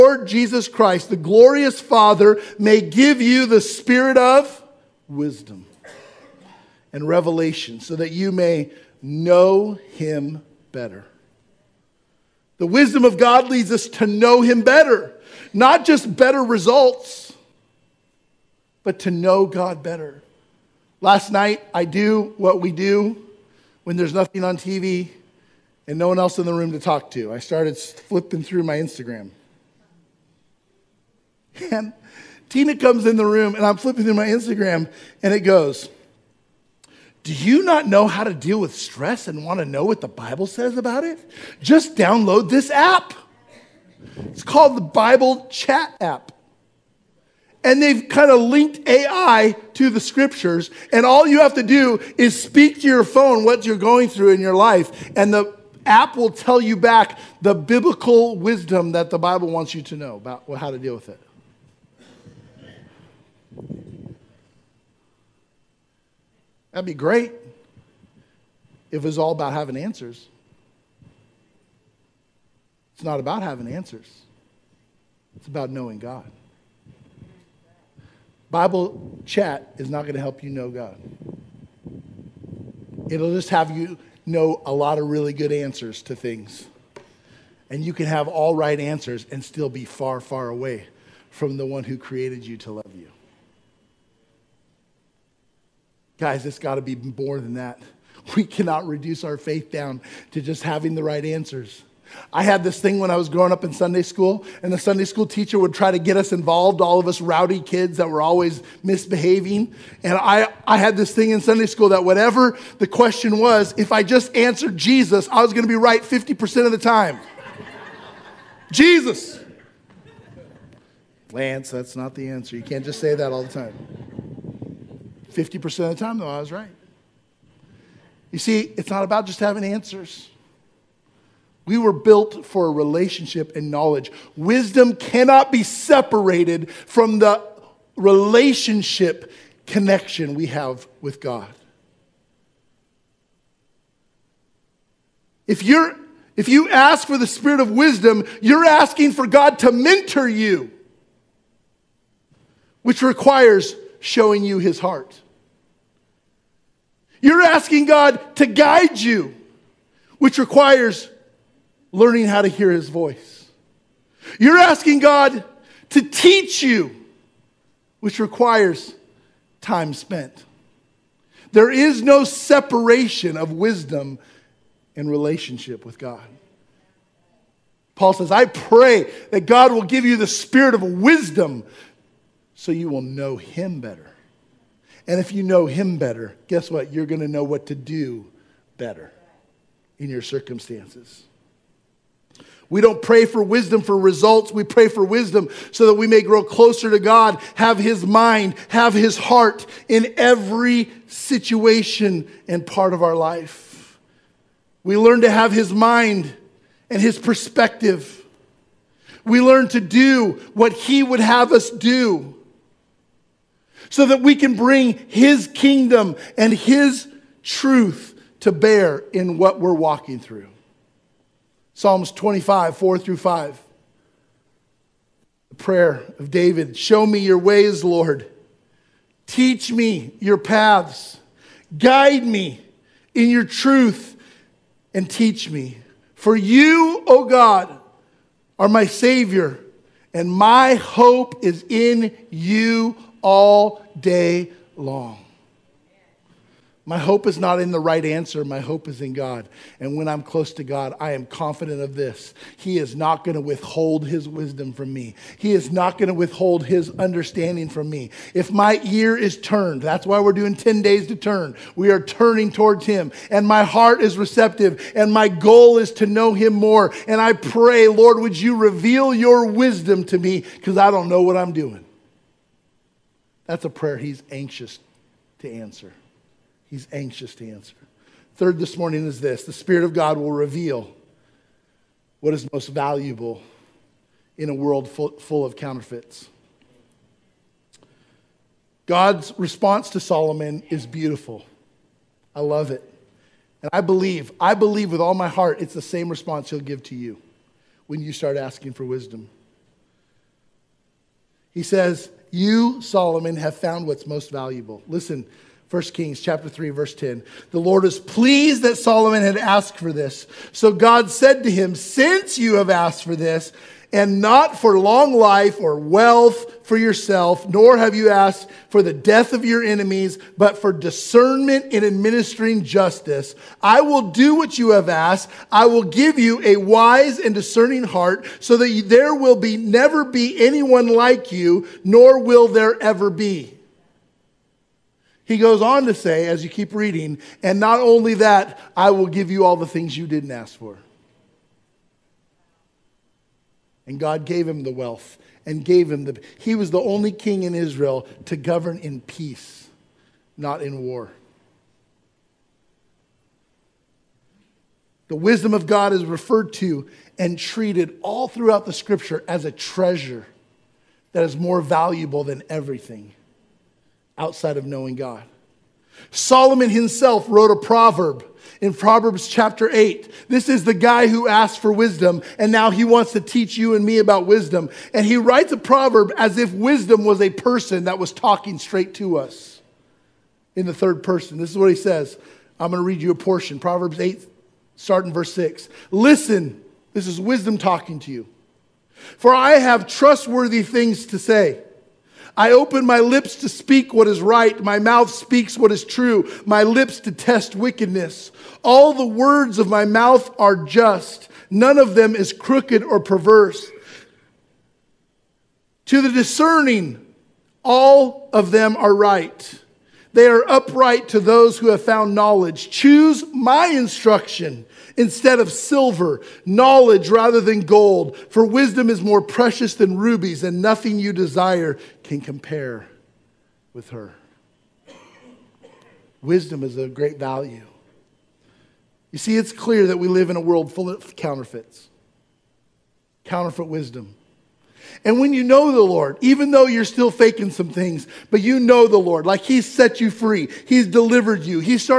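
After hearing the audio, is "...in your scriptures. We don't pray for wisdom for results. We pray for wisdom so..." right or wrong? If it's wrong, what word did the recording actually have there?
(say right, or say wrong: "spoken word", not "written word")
wrong: "circumstances", not "scriptures".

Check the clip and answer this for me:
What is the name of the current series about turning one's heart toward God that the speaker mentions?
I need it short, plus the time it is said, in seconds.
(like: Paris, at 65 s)
10 days to turn, at 260 s.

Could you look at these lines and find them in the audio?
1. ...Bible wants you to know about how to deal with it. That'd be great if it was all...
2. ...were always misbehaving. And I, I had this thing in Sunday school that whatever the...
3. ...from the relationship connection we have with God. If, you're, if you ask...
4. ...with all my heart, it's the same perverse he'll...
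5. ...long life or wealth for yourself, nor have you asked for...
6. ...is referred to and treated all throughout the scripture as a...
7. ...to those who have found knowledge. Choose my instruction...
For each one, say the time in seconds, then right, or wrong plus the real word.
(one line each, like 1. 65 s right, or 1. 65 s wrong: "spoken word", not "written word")
1. 59 s right
2. 108 s right
3. 136 s right
4. 294 s wrong: "response", not "perverse"
5. 314 s right
6. 355 s right
7. 411 s right.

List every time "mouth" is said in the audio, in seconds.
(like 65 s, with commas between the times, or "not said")
394 s, 399 s.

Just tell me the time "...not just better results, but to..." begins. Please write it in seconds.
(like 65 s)
15 s.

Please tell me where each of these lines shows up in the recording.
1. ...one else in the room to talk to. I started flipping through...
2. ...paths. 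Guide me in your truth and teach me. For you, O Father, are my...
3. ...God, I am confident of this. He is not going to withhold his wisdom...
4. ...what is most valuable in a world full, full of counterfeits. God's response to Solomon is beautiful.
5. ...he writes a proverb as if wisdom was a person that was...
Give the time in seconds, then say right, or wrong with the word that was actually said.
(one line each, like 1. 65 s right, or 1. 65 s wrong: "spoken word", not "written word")
1. 26 s right
2. 230 s wrong: "God", not "Father"
3. 250 s right
4. 282 s right
5. 375 s right.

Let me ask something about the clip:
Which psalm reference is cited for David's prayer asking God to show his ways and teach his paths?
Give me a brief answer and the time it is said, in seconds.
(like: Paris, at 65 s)
Psalms 25:4-5, at 221 s.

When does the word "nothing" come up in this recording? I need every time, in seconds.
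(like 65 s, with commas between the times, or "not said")
24 s, 420 s.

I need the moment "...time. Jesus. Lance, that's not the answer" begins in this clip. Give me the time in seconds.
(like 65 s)
116 s.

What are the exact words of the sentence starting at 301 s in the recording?
He says, You, Solomon, have found what's most valuable.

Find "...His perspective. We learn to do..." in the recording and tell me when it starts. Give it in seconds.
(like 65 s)
207 s.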